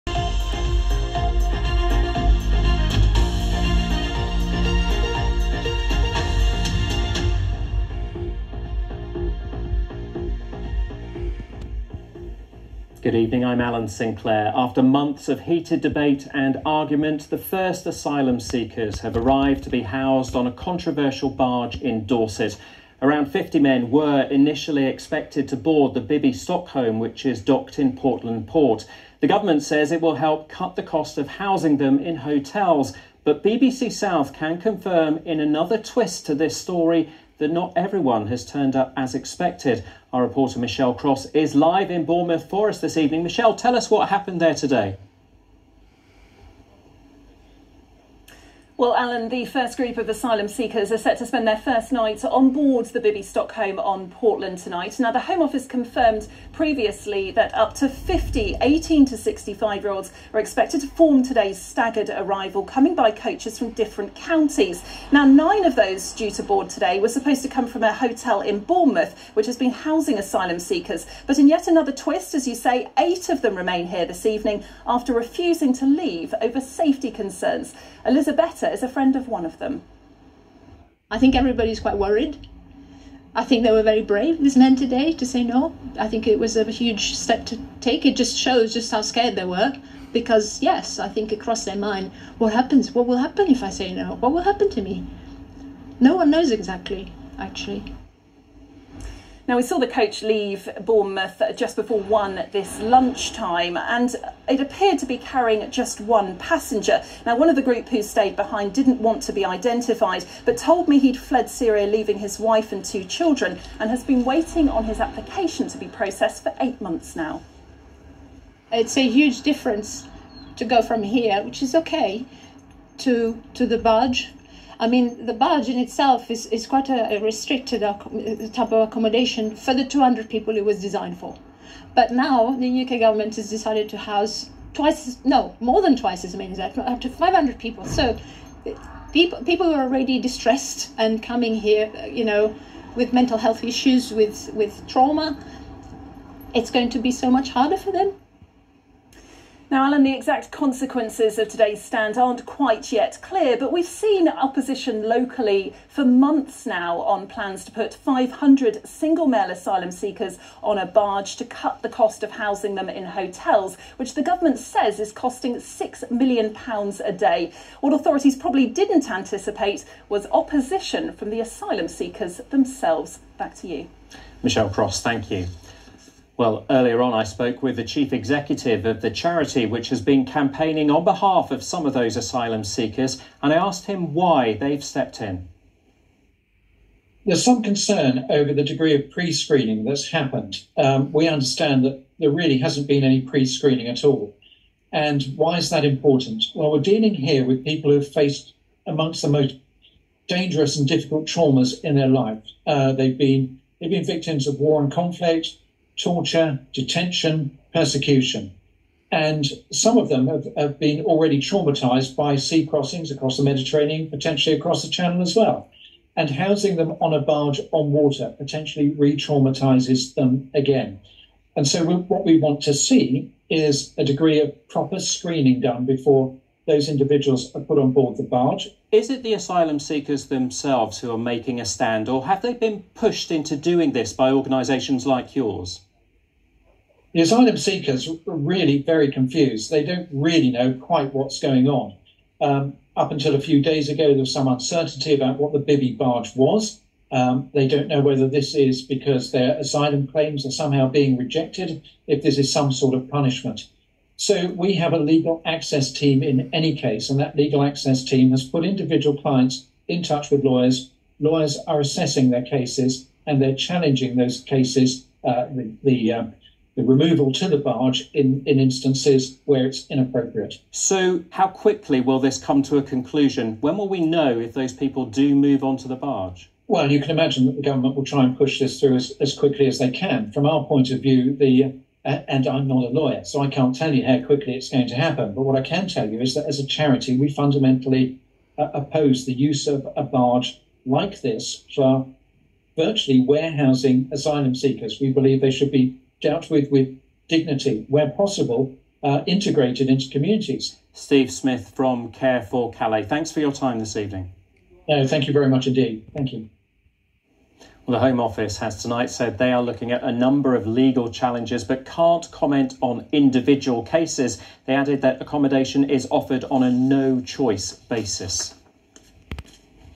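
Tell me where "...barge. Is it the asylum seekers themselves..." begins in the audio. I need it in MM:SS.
03:48.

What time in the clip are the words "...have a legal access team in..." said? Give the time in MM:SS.
04:14.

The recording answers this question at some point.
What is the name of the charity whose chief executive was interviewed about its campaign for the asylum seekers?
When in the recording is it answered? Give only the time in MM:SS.
05:02.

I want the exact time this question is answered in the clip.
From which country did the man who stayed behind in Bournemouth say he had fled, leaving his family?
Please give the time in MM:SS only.
01:51.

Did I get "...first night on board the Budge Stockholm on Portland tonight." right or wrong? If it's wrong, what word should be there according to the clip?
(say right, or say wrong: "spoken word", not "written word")
wrong: "Bibby", not "Budge".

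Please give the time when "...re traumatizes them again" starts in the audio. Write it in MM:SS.
03:38.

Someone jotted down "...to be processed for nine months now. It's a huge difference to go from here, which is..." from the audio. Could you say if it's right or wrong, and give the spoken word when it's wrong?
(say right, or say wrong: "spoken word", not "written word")
wrong: "eight", not "nine".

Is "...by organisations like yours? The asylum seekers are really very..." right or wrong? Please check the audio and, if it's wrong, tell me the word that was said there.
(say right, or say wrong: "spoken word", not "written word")
right.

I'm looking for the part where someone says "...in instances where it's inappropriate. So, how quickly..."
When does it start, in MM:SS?
04:28.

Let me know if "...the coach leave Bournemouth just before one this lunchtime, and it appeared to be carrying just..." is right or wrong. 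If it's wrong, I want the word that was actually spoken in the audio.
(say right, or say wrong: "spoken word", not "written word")
right.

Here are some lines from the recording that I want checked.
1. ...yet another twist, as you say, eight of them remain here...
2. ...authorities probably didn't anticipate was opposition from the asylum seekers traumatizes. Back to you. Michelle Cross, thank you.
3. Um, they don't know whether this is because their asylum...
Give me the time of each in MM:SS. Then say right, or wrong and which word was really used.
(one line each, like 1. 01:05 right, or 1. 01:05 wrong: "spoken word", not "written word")
1. 01:11 right
2. 02:47 wrong: "themselves", not "traumatizes"
3. 04:07 right.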